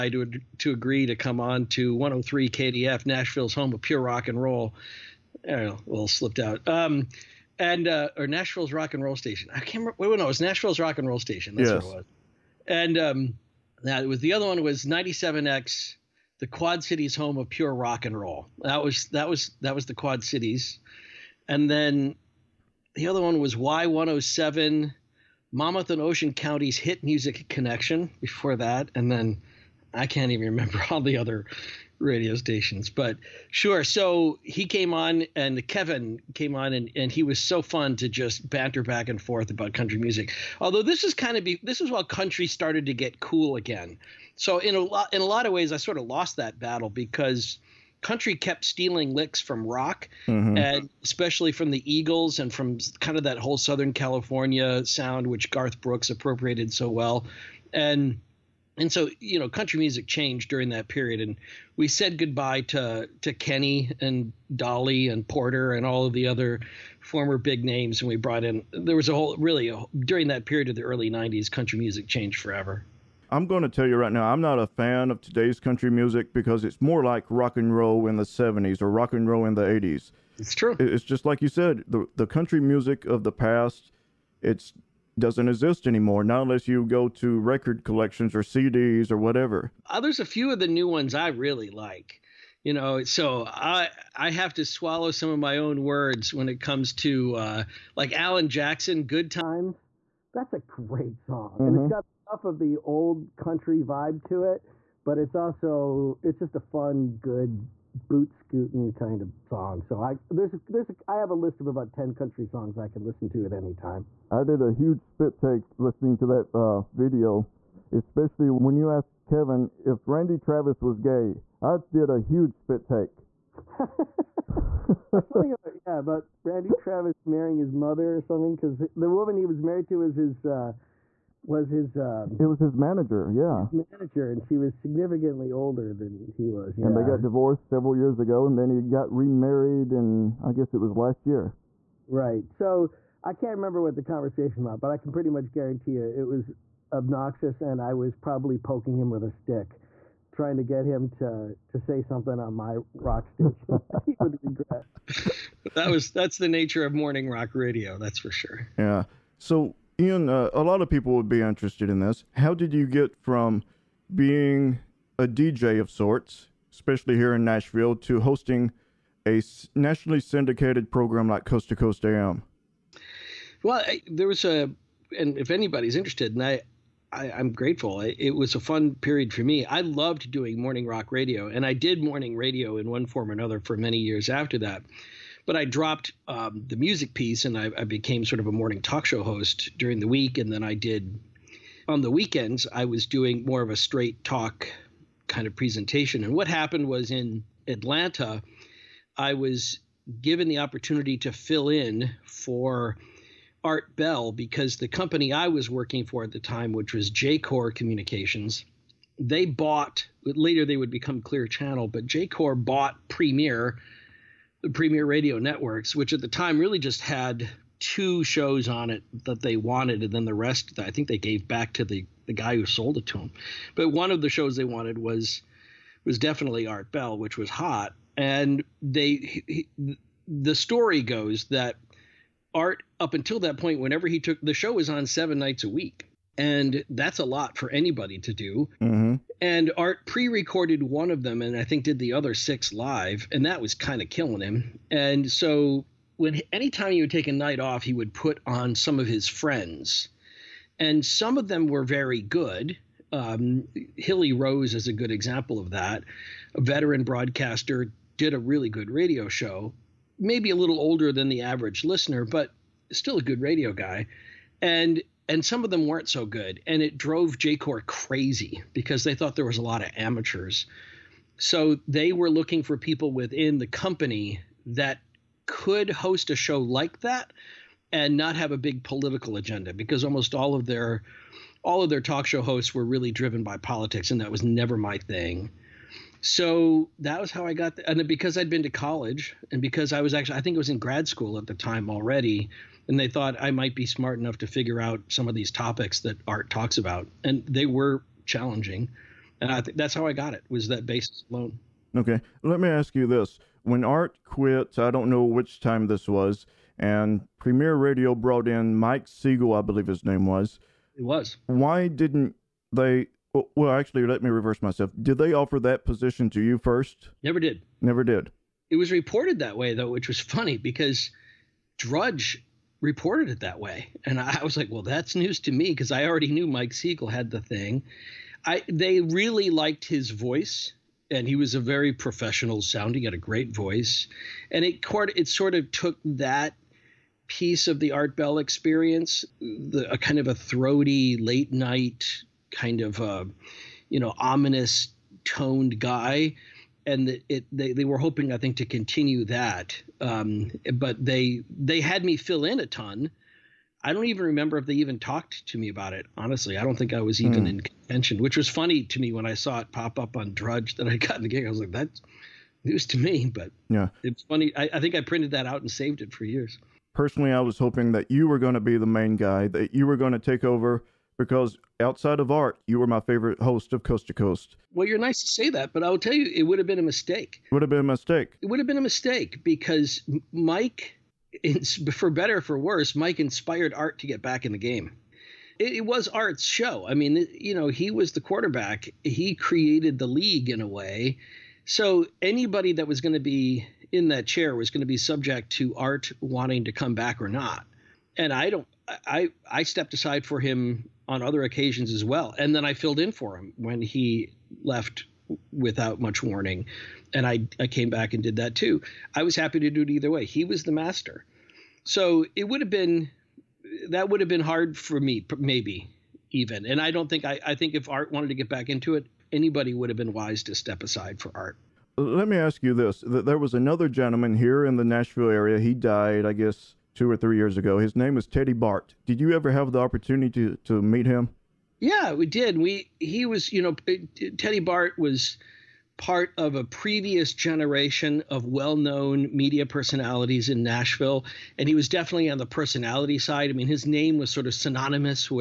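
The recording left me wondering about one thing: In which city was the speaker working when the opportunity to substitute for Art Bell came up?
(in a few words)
Atlanta.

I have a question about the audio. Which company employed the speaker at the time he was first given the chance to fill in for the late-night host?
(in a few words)
Jacor Communications.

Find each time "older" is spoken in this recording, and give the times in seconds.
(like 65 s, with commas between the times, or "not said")
135 s, 260 s.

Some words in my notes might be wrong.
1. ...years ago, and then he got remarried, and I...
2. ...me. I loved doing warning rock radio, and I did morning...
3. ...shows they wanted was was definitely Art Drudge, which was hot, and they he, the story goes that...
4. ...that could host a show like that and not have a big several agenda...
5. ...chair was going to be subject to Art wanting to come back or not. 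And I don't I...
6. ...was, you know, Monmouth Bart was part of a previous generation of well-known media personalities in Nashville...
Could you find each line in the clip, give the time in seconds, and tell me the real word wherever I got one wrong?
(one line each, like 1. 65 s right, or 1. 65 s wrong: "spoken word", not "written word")
1. 137 s right
2. 179 s wrong: "morning", not "warning"
3. 224 s wrong: "Bell", not "Drudge"
4. 274 s wrong: "political", not "several"
5. 394 s right
6. 433 s wrong: "Teddy", not "Monmouth".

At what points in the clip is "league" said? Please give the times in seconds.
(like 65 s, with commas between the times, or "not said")
390 s.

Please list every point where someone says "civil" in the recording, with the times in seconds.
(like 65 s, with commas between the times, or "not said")
not said.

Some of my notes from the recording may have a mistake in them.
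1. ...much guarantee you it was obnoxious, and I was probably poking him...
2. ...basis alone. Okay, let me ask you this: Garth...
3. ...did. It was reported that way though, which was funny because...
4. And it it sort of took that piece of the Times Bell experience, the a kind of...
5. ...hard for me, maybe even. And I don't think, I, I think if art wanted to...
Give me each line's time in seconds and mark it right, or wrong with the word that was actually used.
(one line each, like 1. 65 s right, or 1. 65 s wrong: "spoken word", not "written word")
1. 145 s right
2. 300 s wrong: "When", not "Garth"
3. 318 s right
4. 334 s wrong: "Art", not "Times"
5. 414 s right.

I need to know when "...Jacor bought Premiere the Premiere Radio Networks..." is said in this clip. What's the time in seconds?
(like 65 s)
212 s.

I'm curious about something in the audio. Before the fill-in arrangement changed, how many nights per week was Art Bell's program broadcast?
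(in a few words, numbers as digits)
7.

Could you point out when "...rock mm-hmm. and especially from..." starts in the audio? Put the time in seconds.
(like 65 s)
49 s.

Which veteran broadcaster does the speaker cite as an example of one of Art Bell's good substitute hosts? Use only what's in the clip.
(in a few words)
Hilly Rose.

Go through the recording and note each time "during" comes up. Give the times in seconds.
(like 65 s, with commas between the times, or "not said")
60 s, 70 s, 189 s.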